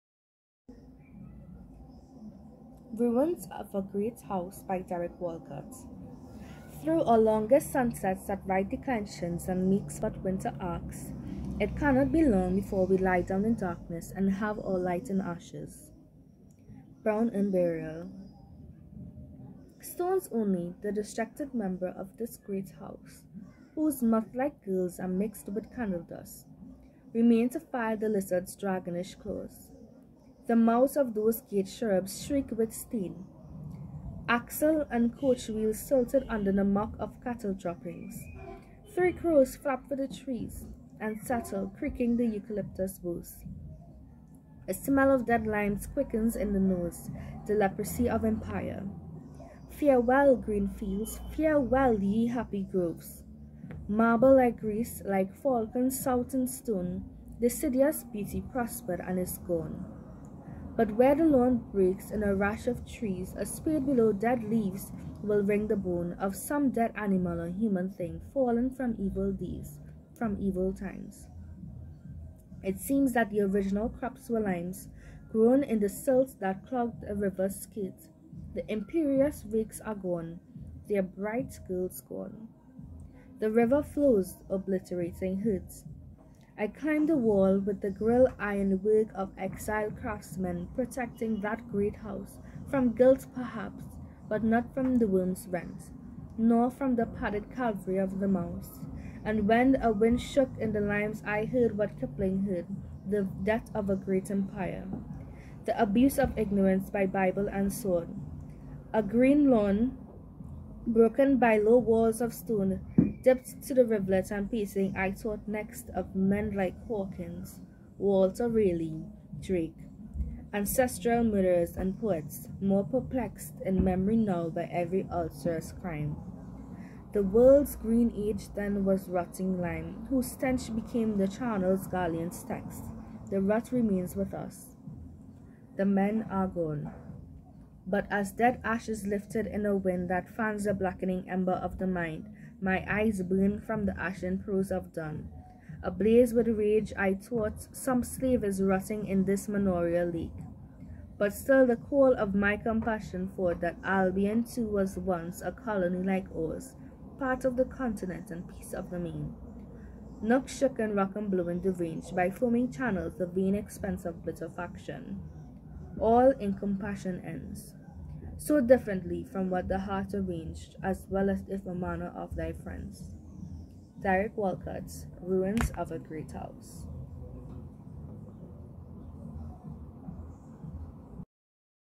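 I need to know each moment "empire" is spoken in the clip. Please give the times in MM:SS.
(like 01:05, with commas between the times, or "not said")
00:48, 01:44.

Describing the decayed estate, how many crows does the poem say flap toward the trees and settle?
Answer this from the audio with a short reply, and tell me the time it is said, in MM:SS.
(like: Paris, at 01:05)
3, at 00:38.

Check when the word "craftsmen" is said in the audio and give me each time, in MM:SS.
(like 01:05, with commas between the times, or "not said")
01:29.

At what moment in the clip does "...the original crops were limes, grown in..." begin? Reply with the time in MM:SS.
01:13.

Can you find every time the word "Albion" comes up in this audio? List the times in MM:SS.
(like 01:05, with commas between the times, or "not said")
02:33.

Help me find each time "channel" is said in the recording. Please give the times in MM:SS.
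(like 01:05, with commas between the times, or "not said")
02:11, 02:42.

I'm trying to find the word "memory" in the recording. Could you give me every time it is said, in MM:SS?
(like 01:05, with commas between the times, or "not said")
02:03.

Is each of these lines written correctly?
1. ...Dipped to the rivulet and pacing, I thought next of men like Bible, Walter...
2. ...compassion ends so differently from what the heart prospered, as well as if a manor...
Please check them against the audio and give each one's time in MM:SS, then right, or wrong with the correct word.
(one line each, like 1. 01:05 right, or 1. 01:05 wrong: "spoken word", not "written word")
1. 01:53 wrong: "Hawkins", not "Bible"
2. 02:46 wrong: "arranged", not "prospered".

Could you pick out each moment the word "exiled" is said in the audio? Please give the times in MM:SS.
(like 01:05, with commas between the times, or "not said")
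01:29.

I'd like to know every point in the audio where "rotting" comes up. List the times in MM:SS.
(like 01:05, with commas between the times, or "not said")
02:09, 02:28.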